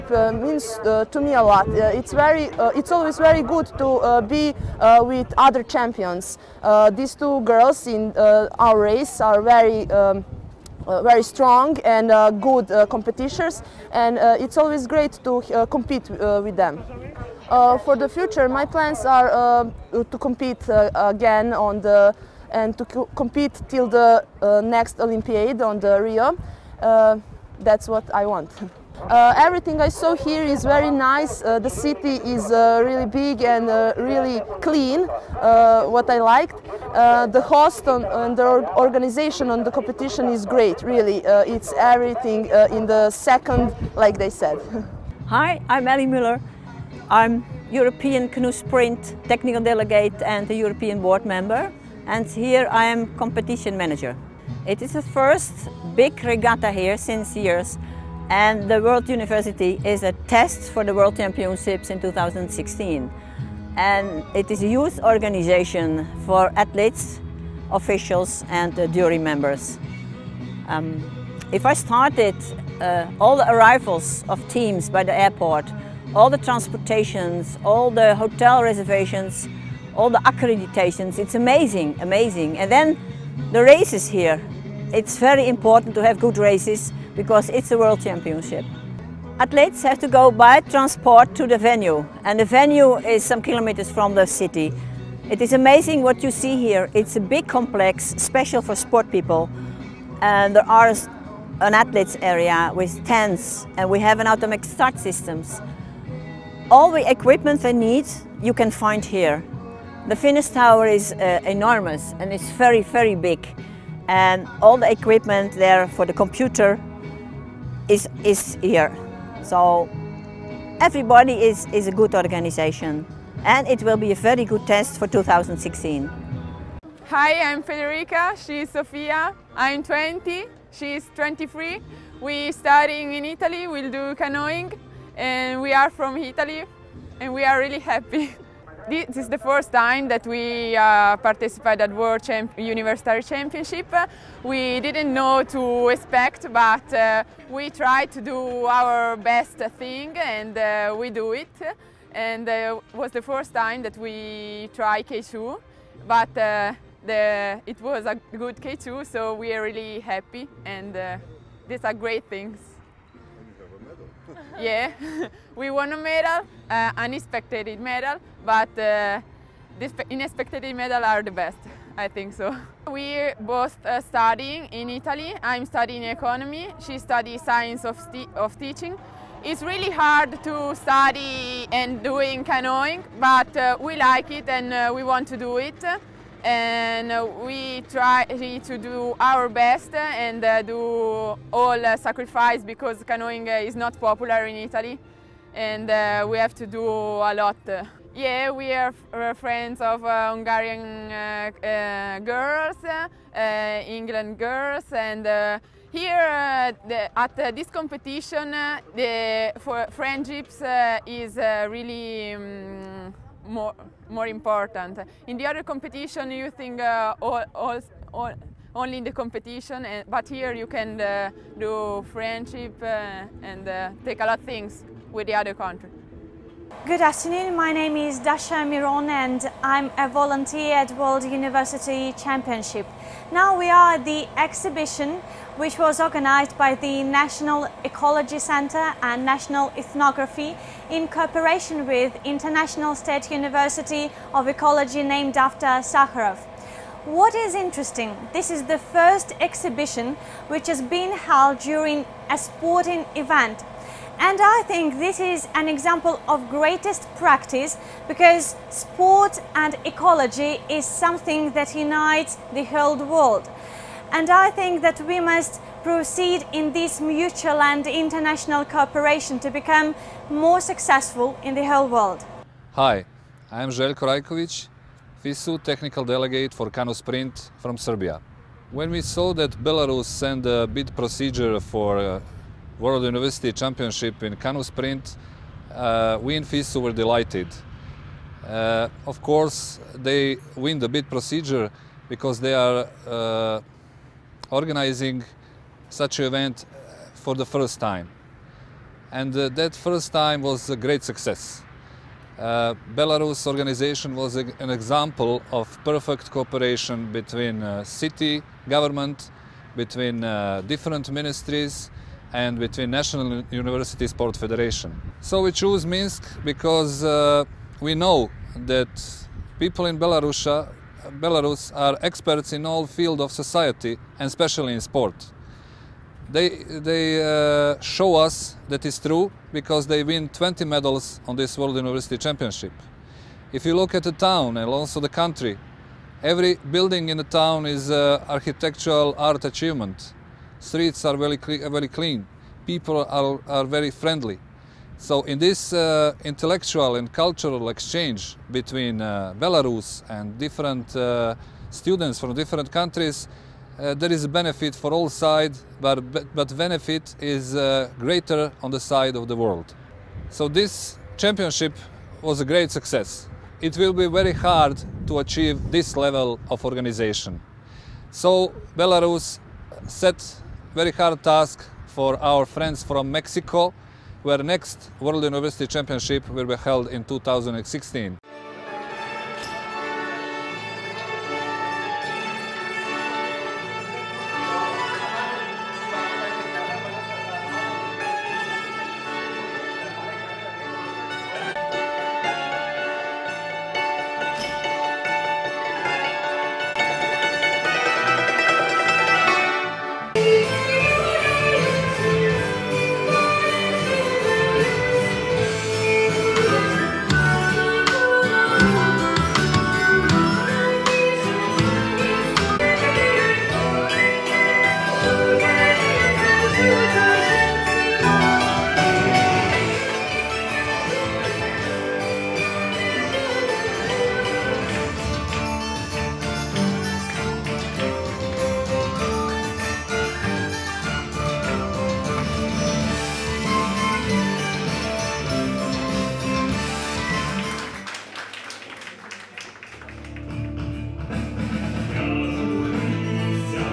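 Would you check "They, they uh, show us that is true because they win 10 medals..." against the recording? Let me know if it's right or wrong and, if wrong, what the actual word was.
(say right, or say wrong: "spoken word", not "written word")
wrong: "20", not "10".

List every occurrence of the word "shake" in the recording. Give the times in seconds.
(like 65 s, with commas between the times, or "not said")
not said.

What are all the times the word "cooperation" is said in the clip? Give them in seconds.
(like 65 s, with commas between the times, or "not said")
241 s, 268 s, 306 s.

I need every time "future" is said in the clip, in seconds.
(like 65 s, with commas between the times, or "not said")
18 s.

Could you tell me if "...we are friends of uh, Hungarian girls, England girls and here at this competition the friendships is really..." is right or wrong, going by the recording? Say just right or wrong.
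right.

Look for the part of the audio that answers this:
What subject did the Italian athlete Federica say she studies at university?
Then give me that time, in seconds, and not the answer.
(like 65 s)
176 s.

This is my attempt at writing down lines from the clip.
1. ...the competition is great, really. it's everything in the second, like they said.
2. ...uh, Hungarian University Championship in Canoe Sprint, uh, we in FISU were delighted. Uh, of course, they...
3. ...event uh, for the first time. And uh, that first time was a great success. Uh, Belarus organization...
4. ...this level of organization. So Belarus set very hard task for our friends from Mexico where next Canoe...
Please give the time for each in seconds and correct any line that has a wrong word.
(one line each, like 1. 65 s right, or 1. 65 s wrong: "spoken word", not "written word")
1. 39 s right
2. 281 s wrong: "World", not "Hungarian"
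3. 296 s right
4. 365 s wrong: "World", not "Canoe".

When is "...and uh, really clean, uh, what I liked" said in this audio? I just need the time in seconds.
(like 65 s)
33 s.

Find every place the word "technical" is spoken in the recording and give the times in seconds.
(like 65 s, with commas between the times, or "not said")
49 s, 275 s.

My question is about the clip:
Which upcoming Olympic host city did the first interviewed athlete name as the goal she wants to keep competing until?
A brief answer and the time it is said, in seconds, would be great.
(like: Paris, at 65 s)
Rio, at 26 s.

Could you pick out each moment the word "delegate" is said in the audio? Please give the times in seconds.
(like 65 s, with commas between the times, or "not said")
49 s, 276 s.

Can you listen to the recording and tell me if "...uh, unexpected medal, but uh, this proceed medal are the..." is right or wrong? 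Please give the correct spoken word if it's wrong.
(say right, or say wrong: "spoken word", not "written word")
wrong: "unexpected", not "proceed".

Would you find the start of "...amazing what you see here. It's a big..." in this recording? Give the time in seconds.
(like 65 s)
95 s.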